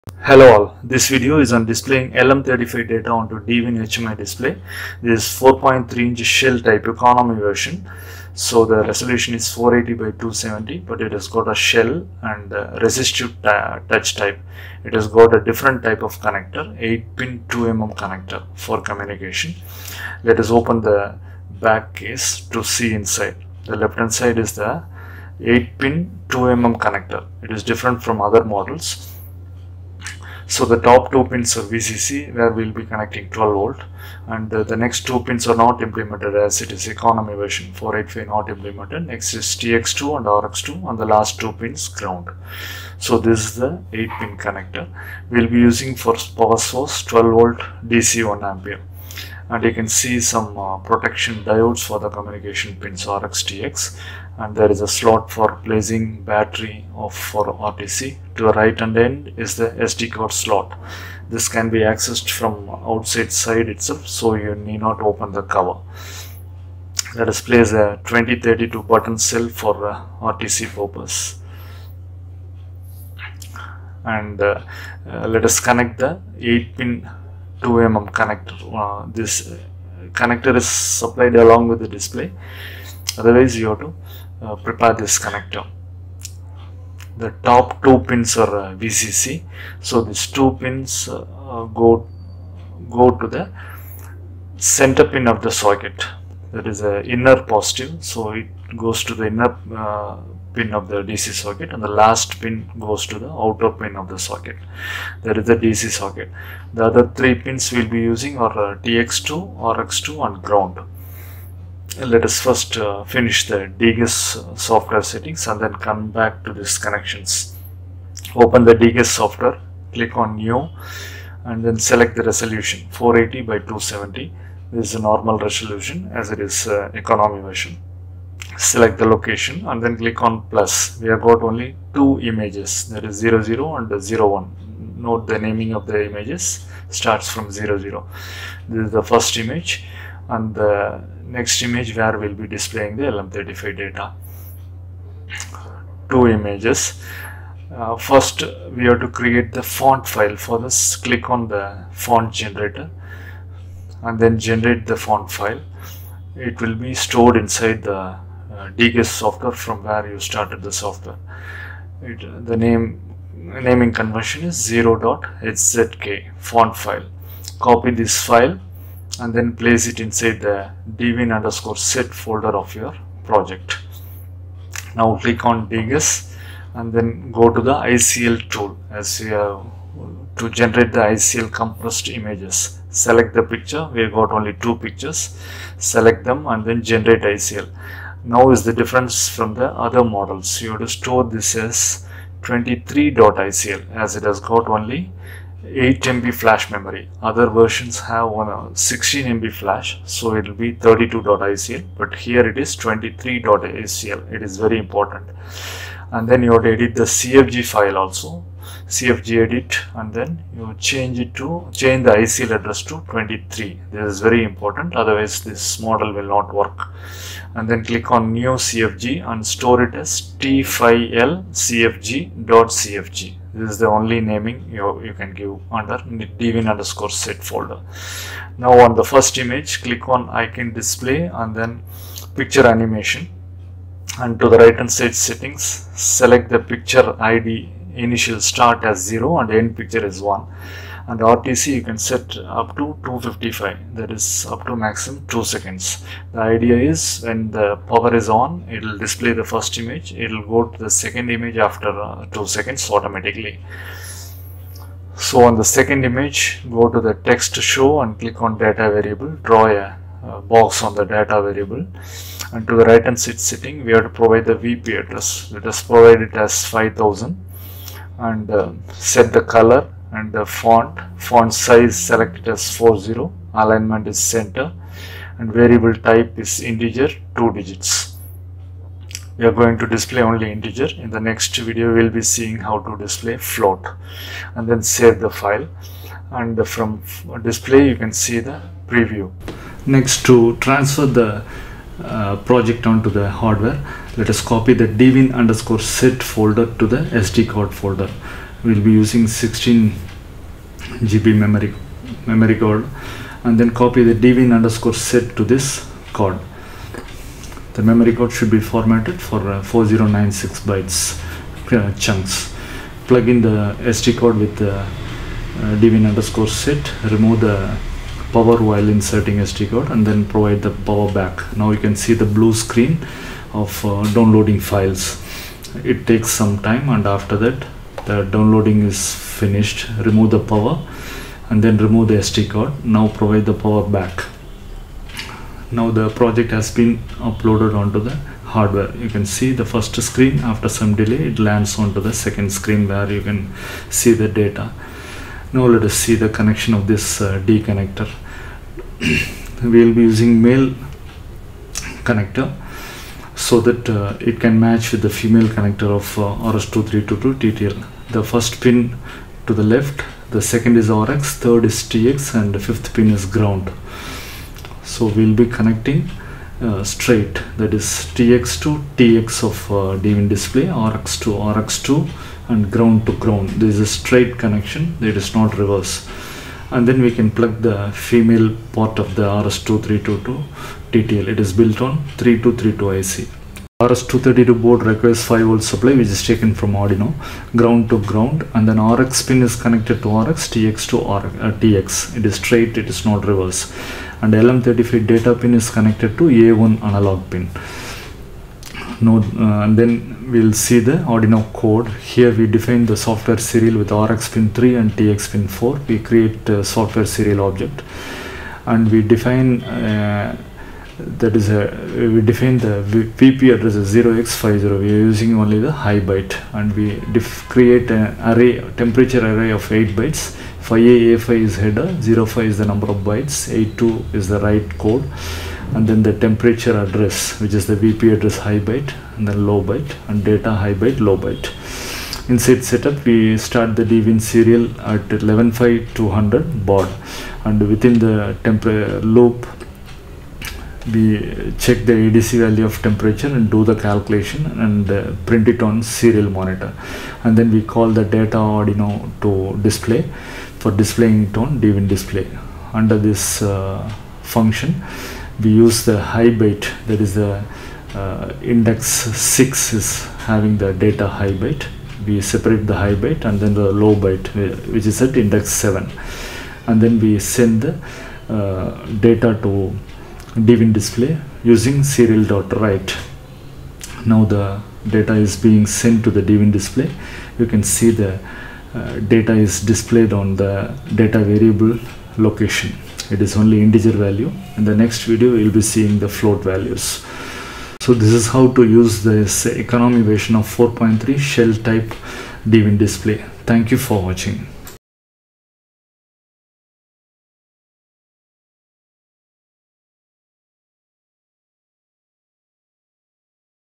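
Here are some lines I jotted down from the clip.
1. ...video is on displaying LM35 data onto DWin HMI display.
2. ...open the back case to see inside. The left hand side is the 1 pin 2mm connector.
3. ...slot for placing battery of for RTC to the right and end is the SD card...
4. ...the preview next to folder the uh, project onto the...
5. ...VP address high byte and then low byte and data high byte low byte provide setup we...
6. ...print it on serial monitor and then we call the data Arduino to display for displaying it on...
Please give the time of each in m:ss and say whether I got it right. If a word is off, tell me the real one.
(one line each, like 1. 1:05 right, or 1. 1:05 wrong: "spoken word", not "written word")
1. 0:01 right
2. 0:20 wrong: "8", not "1"
3. 0:54 right
4. 4:48 wrong: "transfer", not "folder"
5. 7:07 wrong: "inside", not "provide"
6. 7:25 right.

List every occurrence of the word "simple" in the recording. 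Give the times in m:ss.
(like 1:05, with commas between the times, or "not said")
not said.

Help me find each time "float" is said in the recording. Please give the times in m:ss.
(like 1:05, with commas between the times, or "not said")
4:43, 8:06.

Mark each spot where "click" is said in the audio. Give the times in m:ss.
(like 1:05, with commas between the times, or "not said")
1:59, 2:09, 2:30, 2:55, 3:37, 3:49, 4:18.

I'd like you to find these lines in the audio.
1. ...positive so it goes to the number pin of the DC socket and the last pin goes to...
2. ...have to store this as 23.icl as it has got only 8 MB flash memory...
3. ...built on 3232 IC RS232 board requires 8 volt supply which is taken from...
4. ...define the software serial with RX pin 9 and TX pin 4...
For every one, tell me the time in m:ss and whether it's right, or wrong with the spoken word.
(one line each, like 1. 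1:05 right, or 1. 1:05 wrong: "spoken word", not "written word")
1. 1:37 wrong: "inner", not "number"
2. 3:10 right
3. 6:21 wrong: "5", not "8"
4. 6:42 wrong: "3", not "9".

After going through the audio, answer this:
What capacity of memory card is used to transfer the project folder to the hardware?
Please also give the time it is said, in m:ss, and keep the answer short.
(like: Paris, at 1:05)
16 GB, at 4:59.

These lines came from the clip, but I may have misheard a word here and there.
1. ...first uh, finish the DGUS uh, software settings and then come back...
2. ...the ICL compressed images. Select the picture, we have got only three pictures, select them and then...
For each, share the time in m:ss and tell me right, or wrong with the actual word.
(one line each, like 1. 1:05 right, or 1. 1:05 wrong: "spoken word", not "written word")
1. 1:52 right
2. 3:00 wrong: "two", not "three".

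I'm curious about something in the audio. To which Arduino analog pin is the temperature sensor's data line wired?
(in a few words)
A1.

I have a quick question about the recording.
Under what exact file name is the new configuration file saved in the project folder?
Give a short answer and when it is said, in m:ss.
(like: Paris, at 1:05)
t5lcfg.cfg, at 3:40.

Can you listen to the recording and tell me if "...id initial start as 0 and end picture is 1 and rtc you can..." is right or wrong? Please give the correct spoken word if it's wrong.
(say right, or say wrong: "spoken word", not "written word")
right.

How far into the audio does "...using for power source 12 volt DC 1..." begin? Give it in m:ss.
0:45.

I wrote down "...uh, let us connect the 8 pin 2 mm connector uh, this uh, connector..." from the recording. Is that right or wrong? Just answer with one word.
right.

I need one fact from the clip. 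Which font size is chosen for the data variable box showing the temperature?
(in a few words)
40.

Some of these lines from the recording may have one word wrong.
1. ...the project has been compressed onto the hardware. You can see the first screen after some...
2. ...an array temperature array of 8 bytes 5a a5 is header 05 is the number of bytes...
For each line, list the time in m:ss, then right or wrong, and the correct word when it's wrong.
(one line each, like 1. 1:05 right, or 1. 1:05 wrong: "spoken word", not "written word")
1. 5:35 wrong: "uploaded", not "compressed"
2. 6:57 right.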